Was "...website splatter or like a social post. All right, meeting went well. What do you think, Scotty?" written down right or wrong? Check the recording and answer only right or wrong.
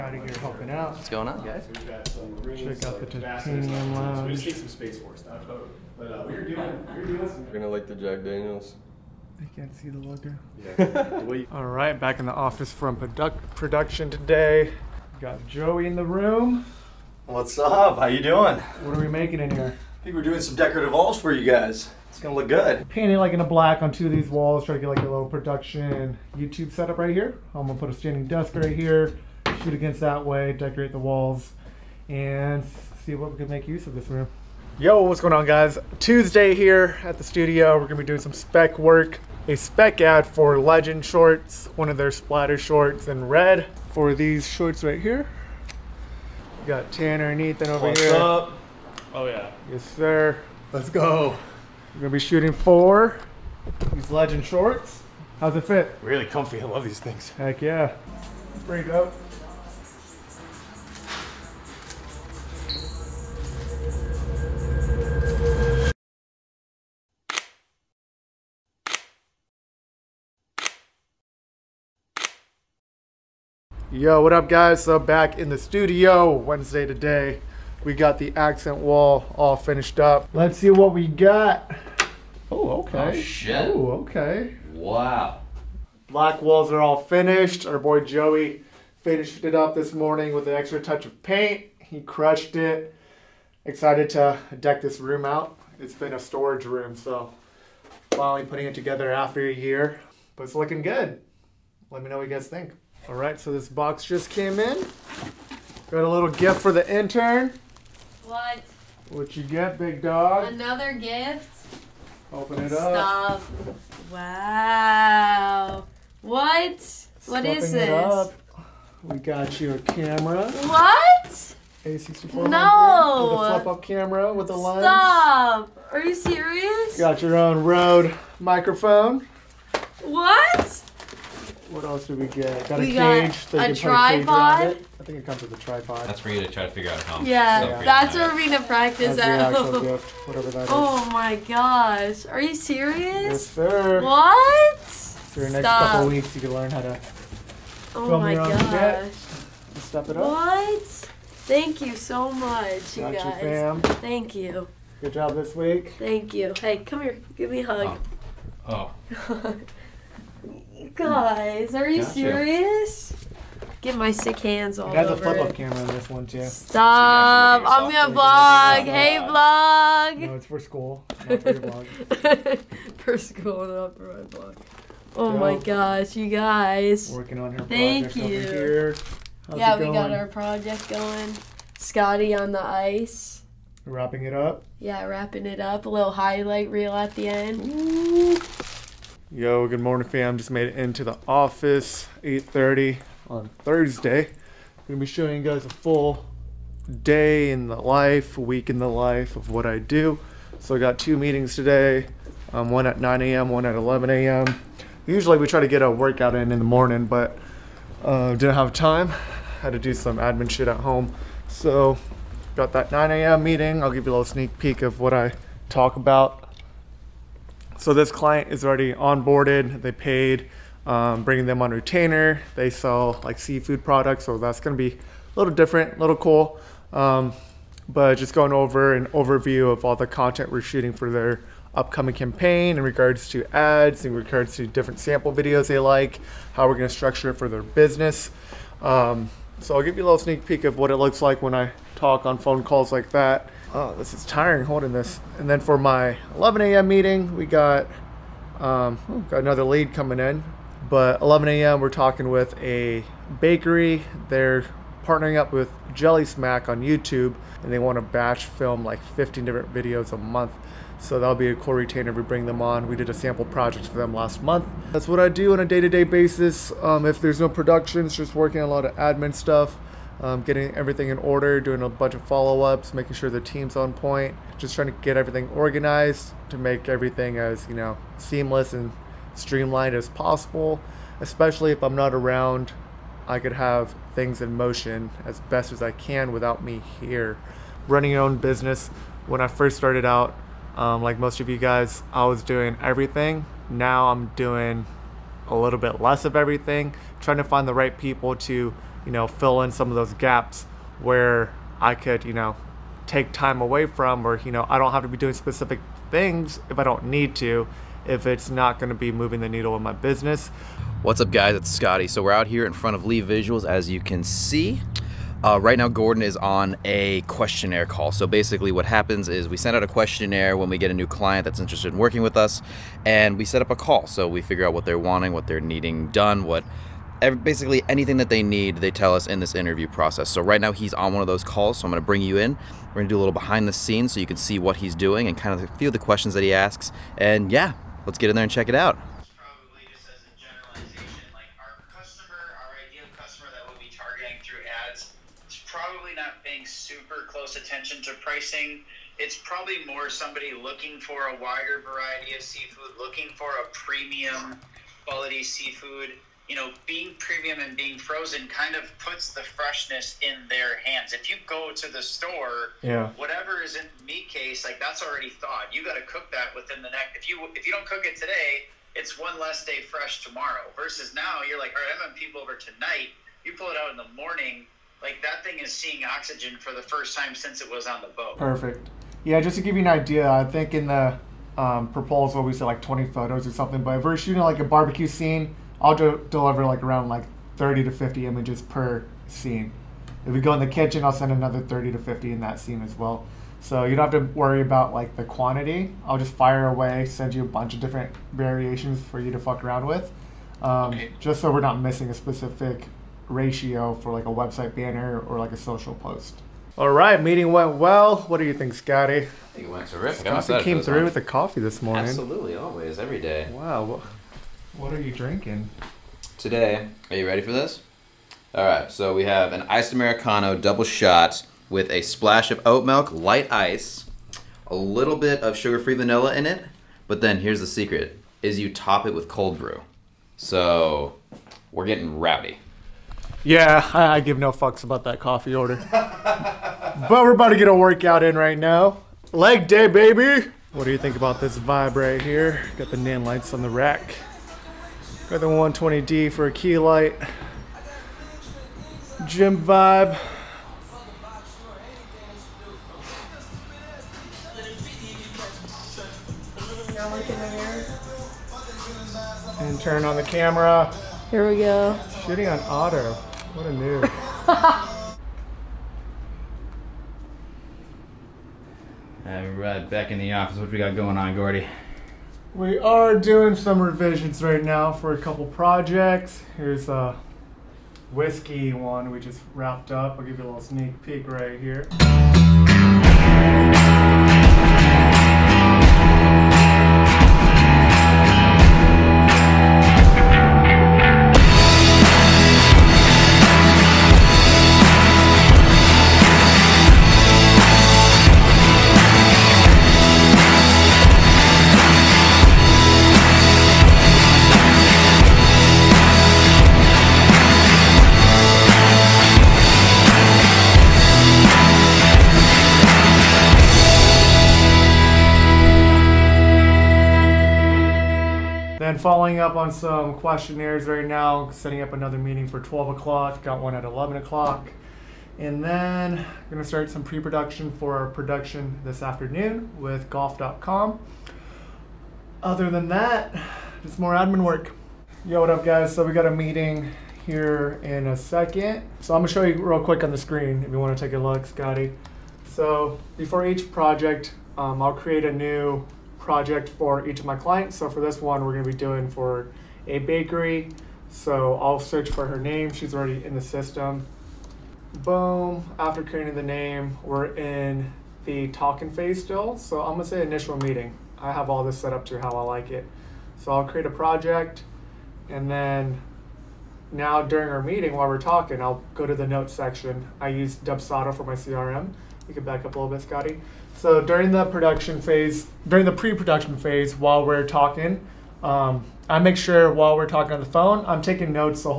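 wrong.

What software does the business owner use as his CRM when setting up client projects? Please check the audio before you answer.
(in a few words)
Dubsado.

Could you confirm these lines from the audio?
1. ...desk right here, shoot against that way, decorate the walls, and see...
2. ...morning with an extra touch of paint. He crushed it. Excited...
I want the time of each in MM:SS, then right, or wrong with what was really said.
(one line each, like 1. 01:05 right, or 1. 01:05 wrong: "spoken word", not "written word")
1. 00:28 right
2. 01:29 right.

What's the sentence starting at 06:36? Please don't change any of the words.
I'll just fire away, send you a bunch of different variations for you to fuck around with.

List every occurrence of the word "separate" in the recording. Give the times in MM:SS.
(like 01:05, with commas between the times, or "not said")
not said.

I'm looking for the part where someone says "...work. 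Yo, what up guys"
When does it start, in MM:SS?
08:54.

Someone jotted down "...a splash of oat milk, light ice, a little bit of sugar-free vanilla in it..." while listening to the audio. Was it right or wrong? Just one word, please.
right.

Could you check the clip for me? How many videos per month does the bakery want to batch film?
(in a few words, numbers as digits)
15.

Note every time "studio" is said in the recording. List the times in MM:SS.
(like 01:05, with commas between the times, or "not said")
00:37, 01:15.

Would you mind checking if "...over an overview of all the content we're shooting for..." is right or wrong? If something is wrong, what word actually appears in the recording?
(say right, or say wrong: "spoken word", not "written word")
right.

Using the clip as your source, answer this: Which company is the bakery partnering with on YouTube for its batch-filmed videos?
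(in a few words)
Jellysmack.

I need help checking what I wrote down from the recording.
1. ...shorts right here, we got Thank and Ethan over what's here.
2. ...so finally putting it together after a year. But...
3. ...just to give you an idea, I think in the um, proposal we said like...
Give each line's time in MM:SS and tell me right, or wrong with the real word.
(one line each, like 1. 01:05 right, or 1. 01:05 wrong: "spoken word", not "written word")
1. 00:44 wrong: "Tanner", not "Thank"
2. 01:36 right
3. 06:19 right.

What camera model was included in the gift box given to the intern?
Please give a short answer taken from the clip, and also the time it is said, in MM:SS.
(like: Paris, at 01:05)
A64, at 02:01.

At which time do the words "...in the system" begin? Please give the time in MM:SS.
09:13.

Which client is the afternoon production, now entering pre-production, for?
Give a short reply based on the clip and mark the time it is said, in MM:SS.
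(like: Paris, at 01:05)
golf.com, at 08:50.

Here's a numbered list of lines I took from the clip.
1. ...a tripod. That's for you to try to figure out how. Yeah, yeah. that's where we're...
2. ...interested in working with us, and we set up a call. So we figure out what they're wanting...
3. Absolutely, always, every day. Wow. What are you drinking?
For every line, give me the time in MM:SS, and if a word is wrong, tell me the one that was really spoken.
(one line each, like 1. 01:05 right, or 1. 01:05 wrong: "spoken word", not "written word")
1. 02:15 right
2. 05:21 right
3. 06:52 right.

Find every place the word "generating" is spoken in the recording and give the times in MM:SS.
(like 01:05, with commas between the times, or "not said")
not said.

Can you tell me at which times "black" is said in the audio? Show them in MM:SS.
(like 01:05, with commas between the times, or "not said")
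00:23, 01:26.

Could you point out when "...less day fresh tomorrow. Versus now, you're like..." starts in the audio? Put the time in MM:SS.
06:09.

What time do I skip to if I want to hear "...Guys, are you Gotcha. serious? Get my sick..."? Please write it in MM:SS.
02:40.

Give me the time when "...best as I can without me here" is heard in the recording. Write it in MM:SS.
04:45.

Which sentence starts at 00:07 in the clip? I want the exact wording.
We're gonna like the Jack Daniels.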